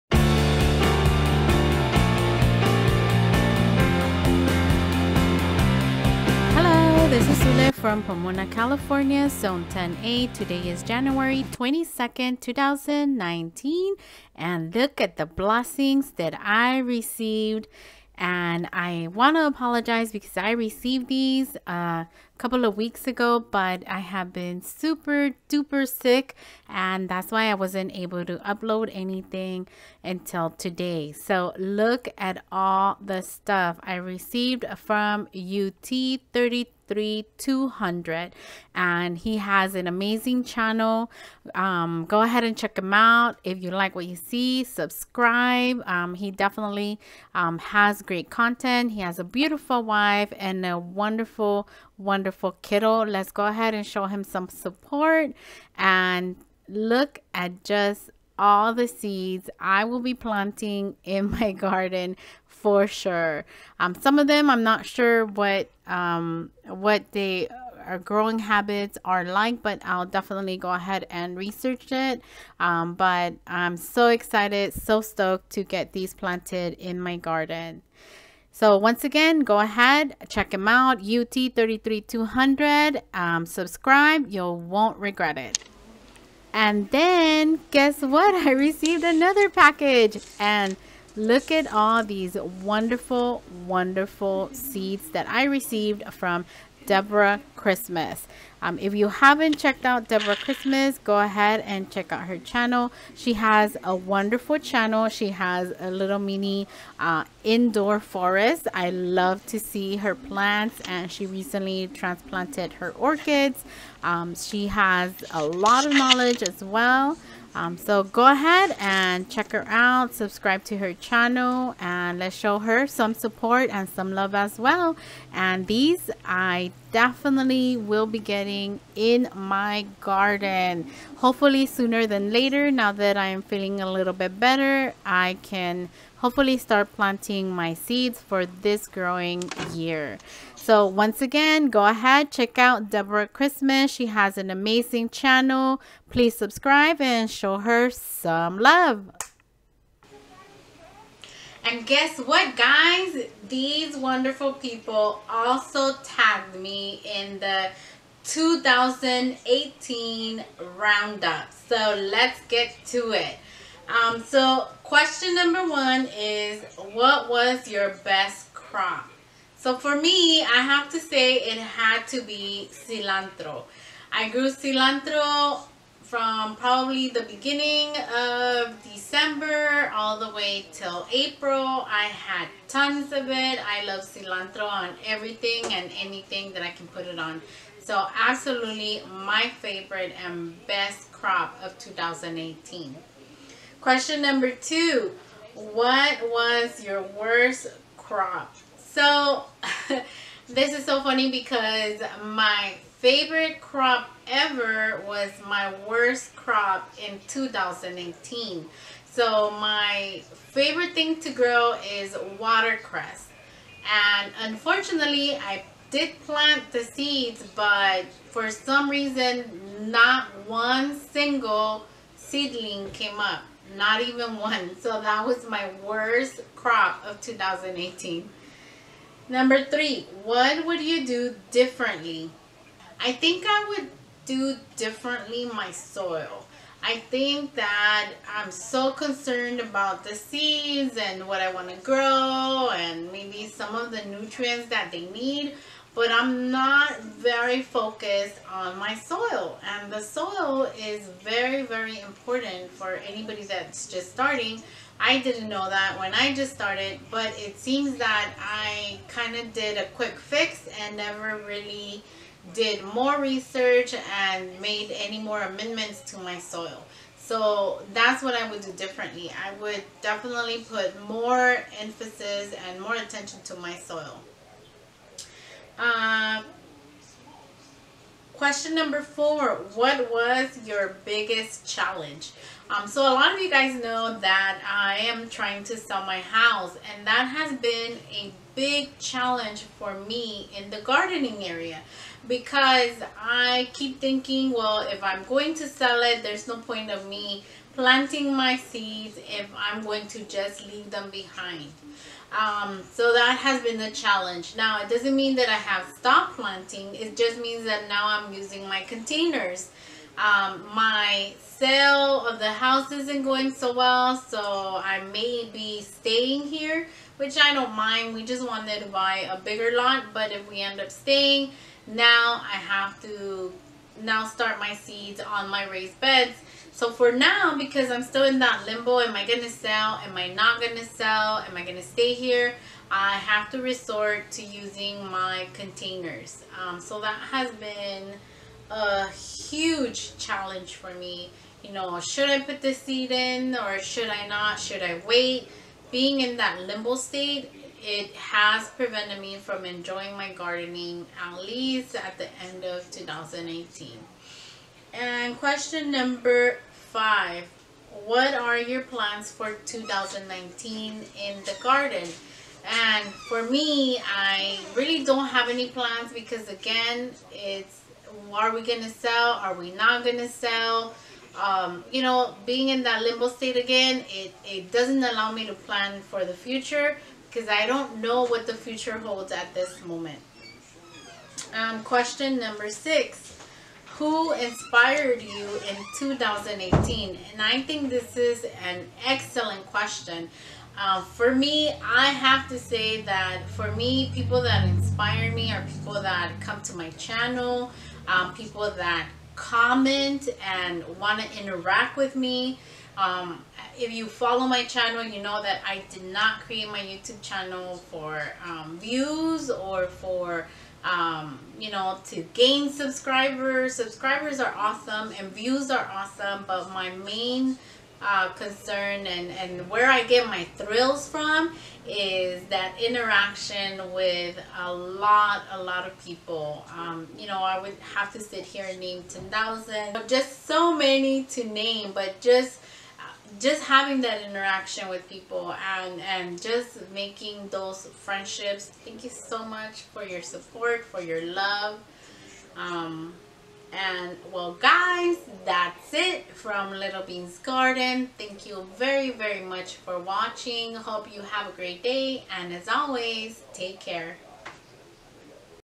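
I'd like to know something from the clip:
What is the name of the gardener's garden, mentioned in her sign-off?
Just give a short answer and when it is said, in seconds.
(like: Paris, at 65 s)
Little Beans Garden, at 446 s.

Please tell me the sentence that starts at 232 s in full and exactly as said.
I think I would do differently my soil.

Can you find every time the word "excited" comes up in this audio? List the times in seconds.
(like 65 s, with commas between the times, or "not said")
74 s.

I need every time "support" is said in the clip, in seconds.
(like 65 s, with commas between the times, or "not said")
54 s, 123 s, 440 s.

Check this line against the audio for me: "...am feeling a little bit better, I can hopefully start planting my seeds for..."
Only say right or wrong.
right.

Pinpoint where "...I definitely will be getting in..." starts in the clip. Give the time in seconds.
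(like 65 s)
126 s.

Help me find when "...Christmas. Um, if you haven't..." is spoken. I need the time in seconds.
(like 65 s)
97 s.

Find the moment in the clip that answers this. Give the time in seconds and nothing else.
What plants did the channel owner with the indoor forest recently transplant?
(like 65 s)
112 s.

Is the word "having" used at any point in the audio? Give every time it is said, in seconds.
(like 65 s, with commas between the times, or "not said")
433 s.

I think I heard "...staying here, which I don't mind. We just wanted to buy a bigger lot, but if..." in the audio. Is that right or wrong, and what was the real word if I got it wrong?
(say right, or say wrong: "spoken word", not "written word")
right.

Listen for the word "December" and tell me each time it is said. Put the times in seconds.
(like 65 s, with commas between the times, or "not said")
178 s.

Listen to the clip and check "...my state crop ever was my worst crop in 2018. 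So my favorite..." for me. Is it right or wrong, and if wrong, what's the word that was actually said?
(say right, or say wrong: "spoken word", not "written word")
wrong: "favorite", not "state".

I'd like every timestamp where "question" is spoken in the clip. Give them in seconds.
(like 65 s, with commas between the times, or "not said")
164 s, 193 s, 278 s, 355 s, 381 s, 389 s.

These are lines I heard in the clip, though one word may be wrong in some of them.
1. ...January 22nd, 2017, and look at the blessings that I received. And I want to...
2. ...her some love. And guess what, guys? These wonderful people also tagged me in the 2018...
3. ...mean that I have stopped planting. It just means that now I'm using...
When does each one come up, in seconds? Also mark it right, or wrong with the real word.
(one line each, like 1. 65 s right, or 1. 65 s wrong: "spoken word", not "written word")
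1. 10 s wrong: "2019", not "2017"
2. 147 s right
3. 305 s right.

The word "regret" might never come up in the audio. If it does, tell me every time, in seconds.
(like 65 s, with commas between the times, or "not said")
84 s.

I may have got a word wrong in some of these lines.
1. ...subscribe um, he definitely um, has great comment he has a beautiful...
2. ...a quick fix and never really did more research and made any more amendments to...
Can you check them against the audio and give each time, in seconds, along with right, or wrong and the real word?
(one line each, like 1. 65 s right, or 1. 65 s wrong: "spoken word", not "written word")
1. 44 s wrong: "content", not "comment"
2. 259 s right.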